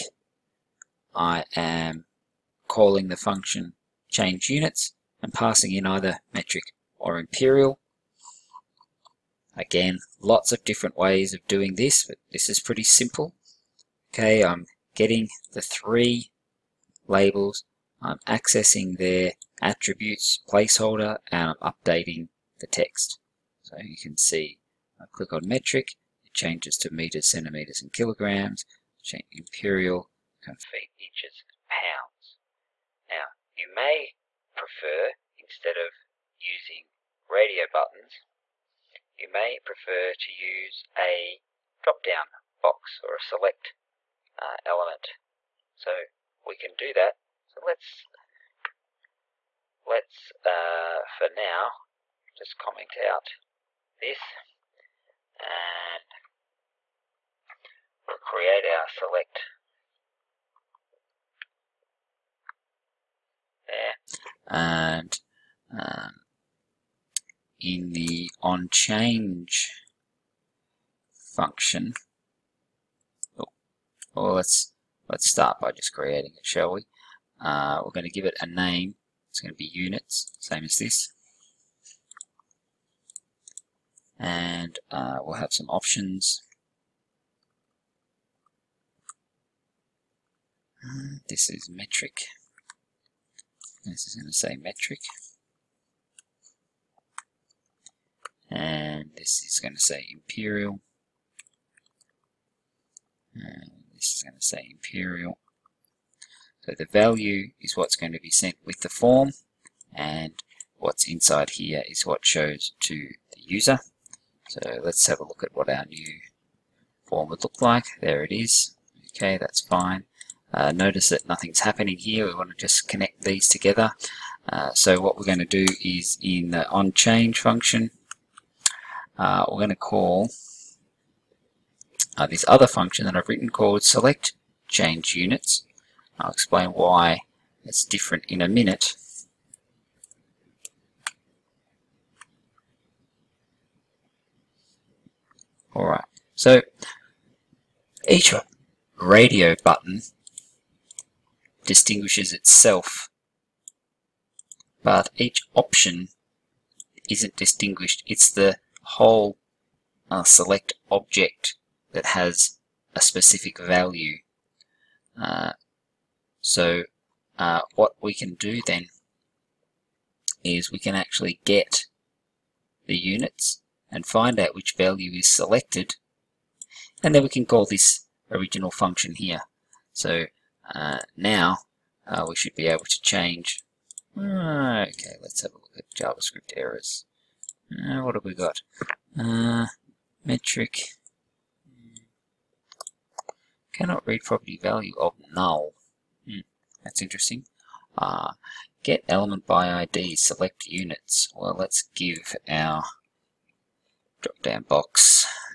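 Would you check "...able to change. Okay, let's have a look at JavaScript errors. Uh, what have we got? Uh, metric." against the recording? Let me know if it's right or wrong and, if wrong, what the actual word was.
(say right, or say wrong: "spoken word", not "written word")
right.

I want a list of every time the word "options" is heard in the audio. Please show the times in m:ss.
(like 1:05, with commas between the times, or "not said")
1:25, 2:35.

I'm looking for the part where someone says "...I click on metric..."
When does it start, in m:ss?
0:25.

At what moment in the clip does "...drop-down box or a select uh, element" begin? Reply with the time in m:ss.
0:41.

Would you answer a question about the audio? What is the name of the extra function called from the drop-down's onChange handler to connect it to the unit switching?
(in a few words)
select change units.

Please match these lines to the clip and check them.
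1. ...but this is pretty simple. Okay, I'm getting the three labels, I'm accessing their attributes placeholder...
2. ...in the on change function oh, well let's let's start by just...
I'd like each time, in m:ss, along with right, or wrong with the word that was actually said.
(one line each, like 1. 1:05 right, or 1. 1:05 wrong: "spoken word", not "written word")
1. 0:12 right
2. 1:07 right.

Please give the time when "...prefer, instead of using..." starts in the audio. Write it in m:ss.
0:34.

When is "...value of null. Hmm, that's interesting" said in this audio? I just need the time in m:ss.
3:14.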